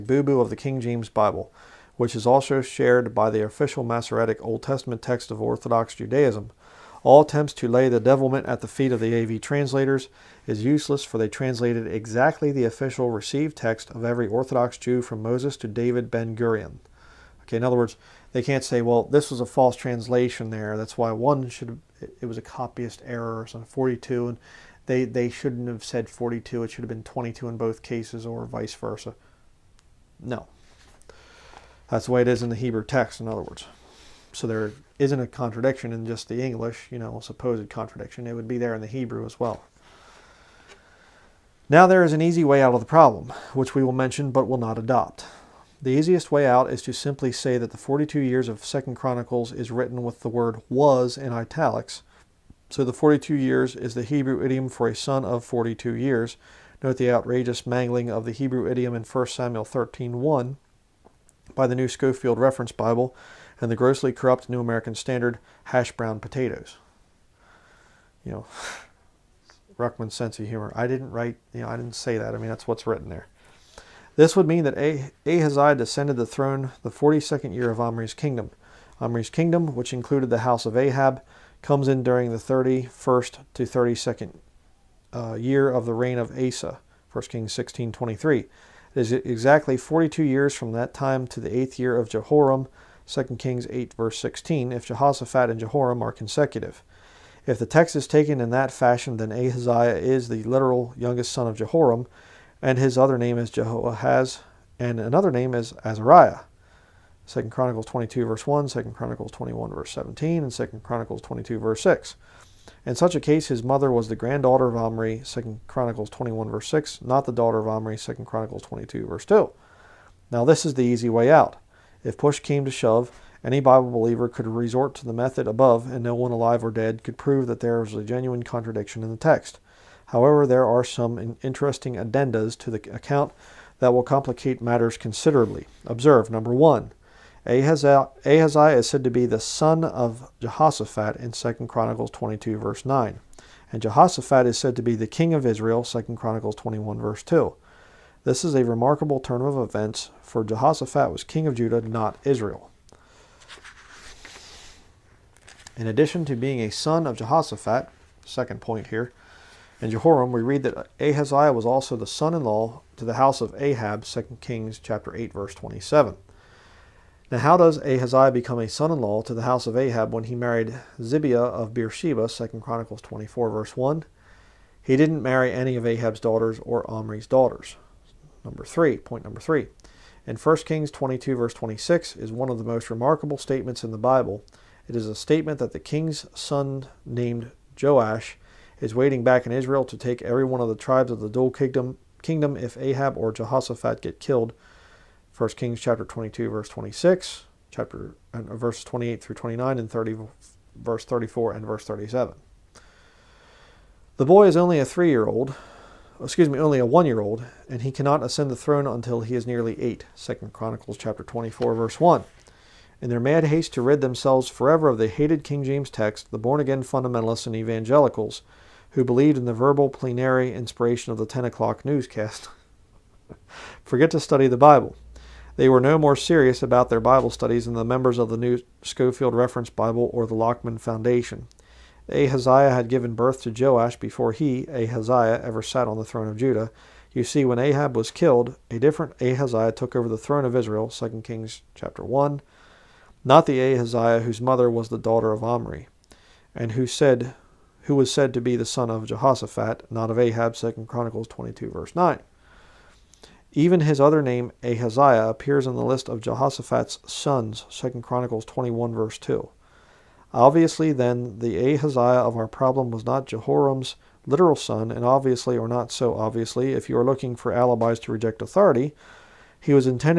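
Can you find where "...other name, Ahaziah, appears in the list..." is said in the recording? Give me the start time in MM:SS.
04:13.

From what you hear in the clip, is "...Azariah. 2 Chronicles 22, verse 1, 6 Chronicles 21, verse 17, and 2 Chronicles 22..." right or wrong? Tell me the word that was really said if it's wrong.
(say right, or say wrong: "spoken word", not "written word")
wrong: "2", not "6".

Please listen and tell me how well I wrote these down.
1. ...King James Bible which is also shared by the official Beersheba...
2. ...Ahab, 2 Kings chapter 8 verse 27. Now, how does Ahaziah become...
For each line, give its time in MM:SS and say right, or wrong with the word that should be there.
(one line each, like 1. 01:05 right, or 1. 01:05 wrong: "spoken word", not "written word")
1. 00:00 wrong: "Masoretic", not "Beersheba"
2. 02:43 right.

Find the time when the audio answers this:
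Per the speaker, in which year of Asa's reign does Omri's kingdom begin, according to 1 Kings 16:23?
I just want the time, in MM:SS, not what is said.
01:22.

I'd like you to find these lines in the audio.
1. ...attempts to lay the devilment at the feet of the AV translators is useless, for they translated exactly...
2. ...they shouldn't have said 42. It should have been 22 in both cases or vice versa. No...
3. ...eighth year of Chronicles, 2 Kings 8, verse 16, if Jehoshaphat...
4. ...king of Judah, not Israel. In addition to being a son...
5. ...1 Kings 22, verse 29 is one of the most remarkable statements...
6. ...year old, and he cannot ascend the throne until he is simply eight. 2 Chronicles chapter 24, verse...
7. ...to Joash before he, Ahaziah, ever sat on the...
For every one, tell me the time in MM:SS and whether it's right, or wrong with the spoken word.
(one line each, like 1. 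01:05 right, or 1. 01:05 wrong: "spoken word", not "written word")
1. 00:07 right
2. 00:25 right
3. 01:31 wrong: "Jehoram", not "Chronicles"
4. 02:31 right
5. 03:00 wrong: "26", not "29"
6. 03:27 wrong: "nearly", not "simply"
7. 03:53 right.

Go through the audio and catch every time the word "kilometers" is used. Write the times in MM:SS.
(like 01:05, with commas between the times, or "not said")
not said.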